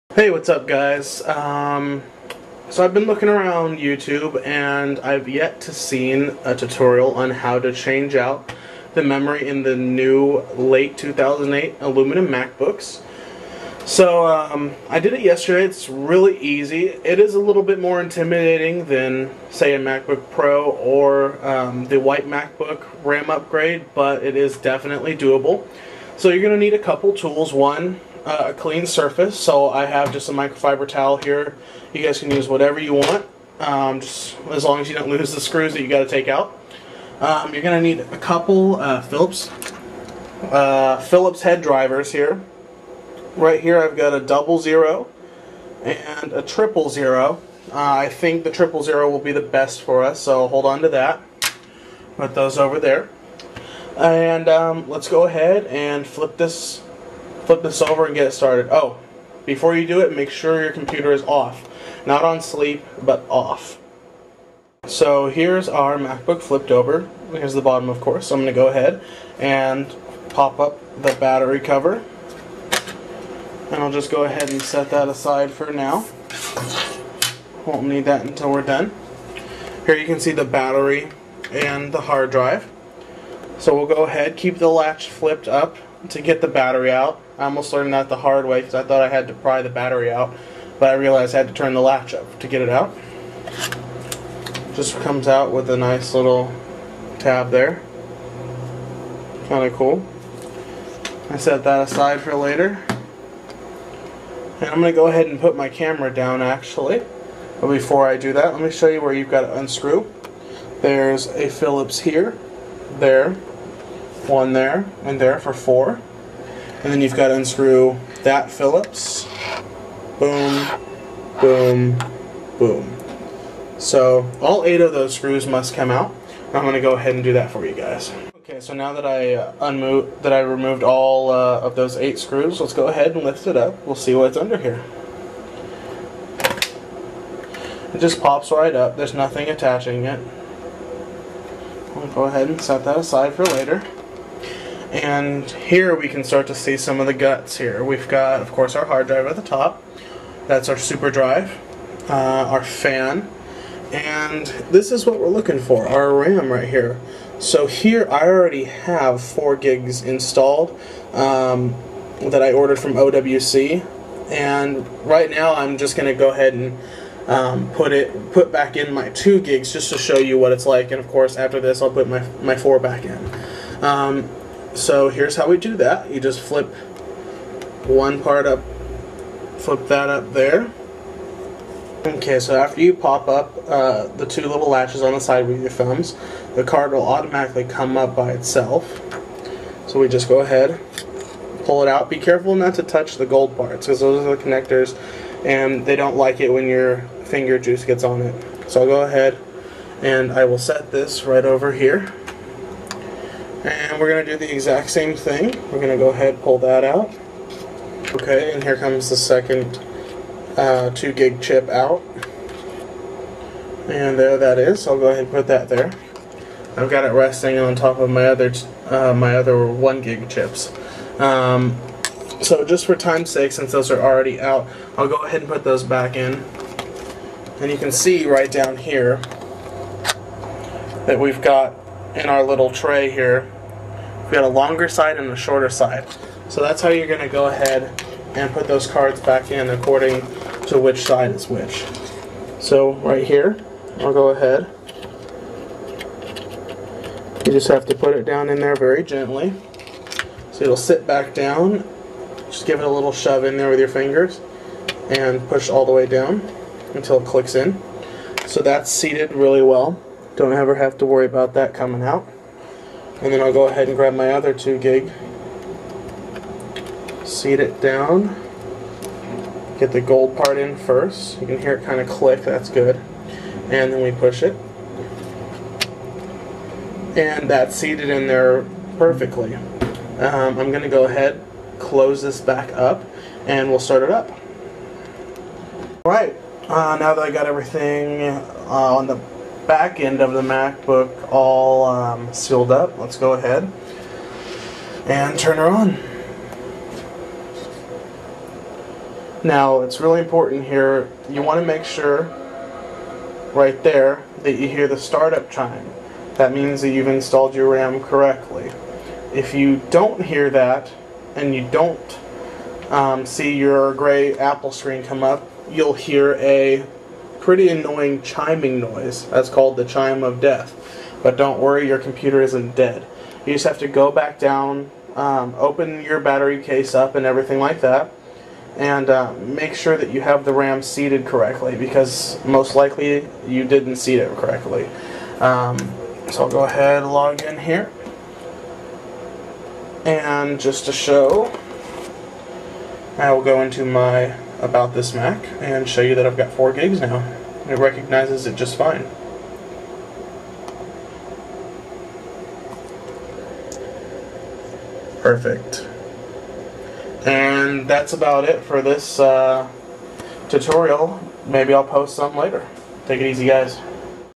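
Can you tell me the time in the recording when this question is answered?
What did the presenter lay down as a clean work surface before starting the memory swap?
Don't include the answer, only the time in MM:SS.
00:30.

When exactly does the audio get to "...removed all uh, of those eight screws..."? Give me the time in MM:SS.
02:10.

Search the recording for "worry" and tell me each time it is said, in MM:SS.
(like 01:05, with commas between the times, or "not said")
04:21, 05:21.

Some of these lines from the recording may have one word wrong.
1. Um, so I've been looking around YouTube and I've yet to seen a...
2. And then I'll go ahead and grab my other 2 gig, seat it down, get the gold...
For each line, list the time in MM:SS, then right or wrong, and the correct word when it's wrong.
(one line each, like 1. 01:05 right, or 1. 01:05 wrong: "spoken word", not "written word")
1. 00:01 right
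2. 04:23 right.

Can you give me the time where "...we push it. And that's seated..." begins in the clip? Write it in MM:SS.
04:34.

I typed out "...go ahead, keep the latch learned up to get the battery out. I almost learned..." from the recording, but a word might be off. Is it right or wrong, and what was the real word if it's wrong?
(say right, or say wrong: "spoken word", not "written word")
wrong: "flipped", not "learned".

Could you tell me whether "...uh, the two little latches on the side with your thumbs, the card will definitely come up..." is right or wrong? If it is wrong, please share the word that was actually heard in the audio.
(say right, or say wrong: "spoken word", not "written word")
wrong: "automatically", not "definitely".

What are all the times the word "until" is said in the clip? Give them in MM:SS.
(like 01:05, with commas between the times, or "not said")
01:18, 04:16.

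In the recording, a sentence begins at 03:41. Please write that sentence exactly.
Um, so just for time's sake, since those are already out, I'll go ahead and put those back in.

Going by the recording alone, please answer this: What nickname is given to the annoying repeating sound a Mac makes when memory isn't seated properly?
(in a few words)
chime of death.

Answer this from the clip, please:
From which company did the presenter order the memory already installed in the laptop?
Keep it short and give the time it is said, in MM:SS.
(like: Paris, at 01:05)
OWC, at 02:42.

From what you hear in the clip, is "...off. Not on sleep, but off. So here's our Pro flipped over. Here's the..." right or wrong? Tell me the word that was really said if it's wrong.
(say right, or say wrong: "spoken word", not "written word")
wrong: "MacBook", not "Pro".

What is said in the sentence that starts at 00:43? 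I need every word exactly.
Right here I've got a double zero and a triple zero.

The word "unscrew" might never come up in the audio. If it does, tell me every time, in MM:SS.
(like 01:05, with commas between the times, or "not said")
01:49, 01:57.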